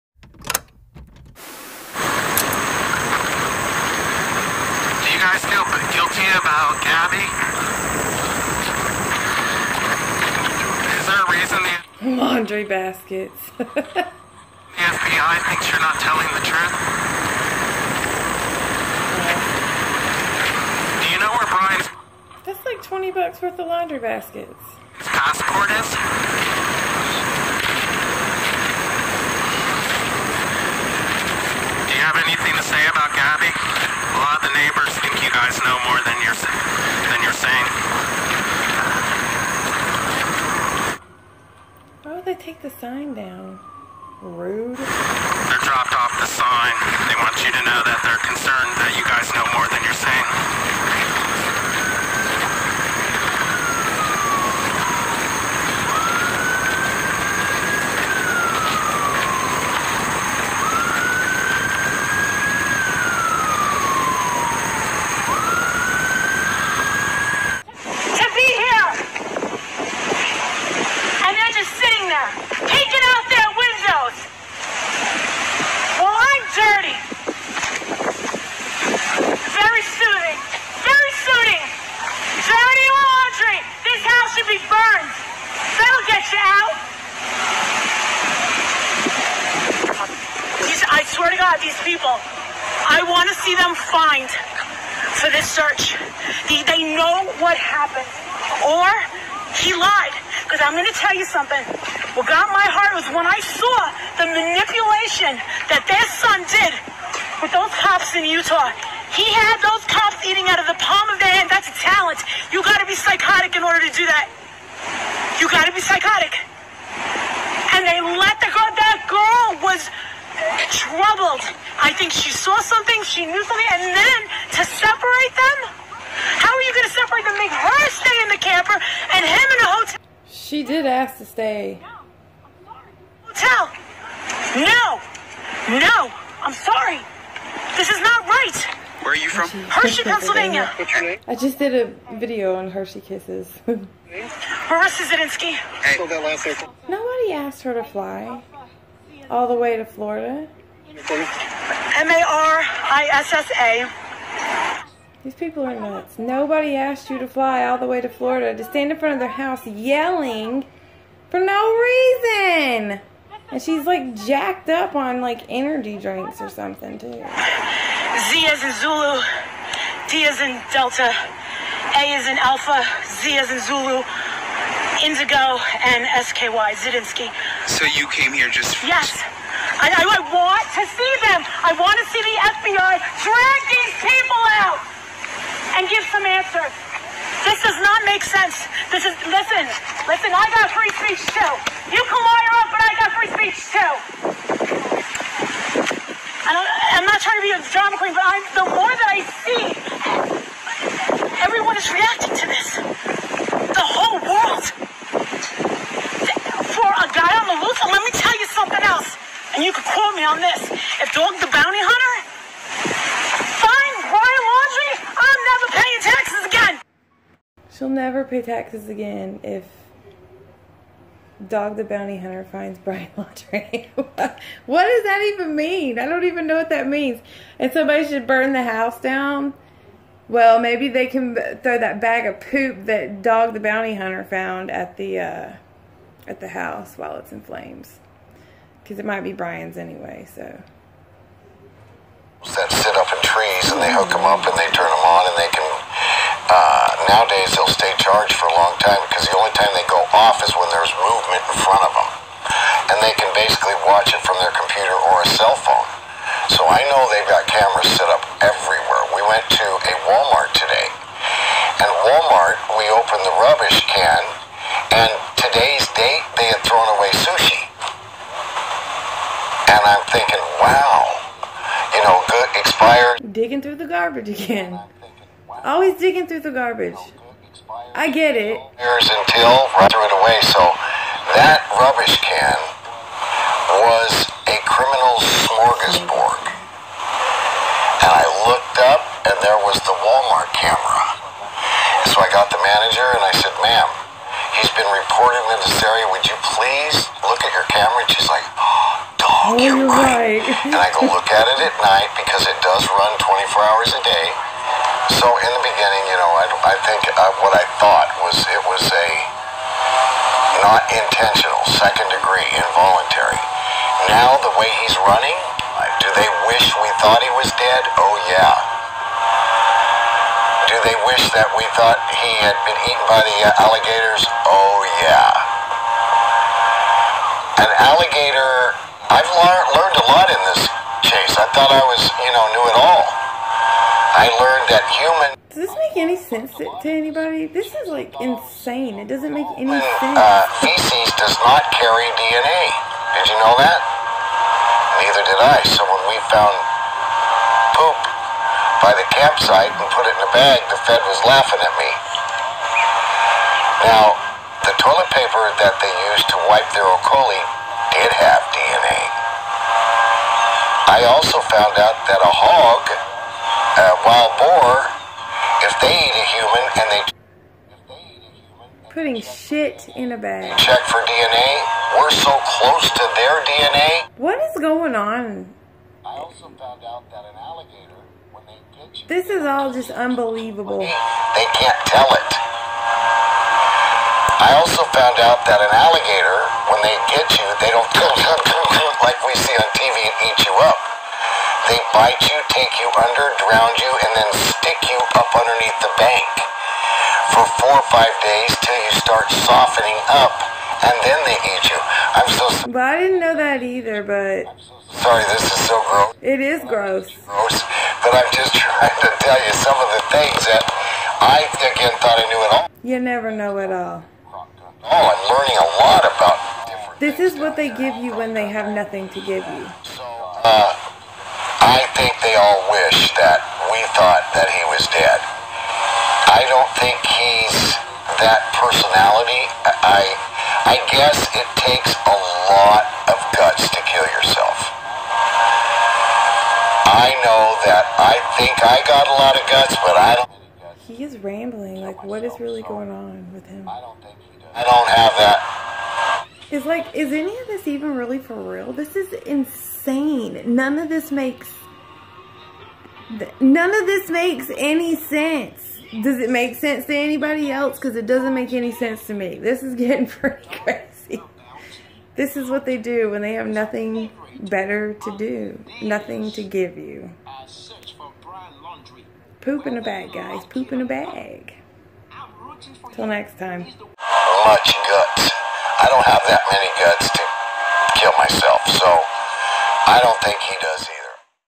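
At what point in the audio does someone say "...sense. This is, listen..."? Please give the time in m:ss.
3:08.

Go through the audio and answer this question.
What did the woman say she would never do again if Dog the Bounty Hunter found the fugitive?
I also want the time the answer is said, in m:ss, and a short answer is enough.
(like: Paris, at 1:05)
pay taxes, at 3:35.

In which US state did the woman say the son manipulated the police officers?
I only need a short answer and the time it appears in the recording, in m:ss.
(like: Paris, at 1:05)
Utah, at 1:48.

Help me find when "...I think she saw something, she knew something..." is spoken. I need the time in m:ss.
2:01.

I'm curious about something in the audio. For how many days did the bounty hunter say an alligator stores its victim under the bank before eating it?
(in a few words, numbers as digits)
4 or 5 days.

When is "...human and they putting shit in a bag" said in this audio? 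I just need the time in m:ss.
6:06.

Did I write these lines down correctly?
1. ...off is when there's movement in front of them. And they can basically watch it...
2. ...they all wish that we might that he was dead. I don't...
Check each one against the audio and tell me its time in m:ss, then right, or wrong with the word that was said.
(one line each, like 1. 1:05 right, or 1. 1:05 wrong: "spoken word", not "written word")
1. 4:10 right
2. 7:02 wrong: "thought", not "might".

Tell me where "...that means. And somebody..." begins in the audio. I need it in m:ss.
3:46.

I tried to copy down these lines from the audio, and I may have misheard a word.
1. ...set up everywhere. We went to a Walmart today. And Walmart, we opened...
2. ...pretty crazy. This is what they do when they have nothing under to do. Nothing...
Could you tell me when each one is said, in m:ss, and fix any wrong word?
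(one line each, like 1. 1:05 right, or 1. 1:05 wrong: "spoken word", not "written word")
1. 4:17 right
2. 7:40 wrong: "better", not "under".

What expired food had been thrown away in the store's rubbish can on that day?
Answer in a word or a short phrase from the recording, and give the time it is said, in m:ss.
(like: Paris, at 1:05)
sushi, at 4:27.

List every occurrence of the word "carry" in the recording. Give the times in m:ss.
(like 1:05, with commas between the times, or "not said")
5:41.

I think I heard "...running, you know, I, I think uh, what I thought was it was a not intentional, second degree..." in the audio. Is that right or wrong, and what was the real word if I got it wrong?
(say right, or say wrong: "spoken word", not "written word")
wrong: "beginning", not "running".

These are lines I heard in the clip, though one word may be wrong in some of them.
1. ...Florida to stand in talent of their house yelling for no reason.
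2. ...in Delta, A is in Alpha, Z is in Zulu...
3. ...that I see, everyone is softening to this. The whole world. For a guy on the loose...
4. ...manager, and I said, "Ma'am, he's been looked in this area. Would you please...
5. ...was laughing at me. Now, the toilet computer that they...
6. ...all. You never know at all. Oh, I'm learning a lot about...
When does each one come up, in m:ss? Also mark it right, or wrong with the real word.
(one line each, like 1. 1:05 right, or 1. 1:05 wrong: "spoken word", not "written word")
1. 2:38 wrong: "front", not "talent"
2. 2:50 right
3. 3:18 wrong: "reacting", not "softening"
4. 4:52 wrong: "reported", not "looked"
5. 5:51 wrong: "paper", not "computer"
6. 6:52 right.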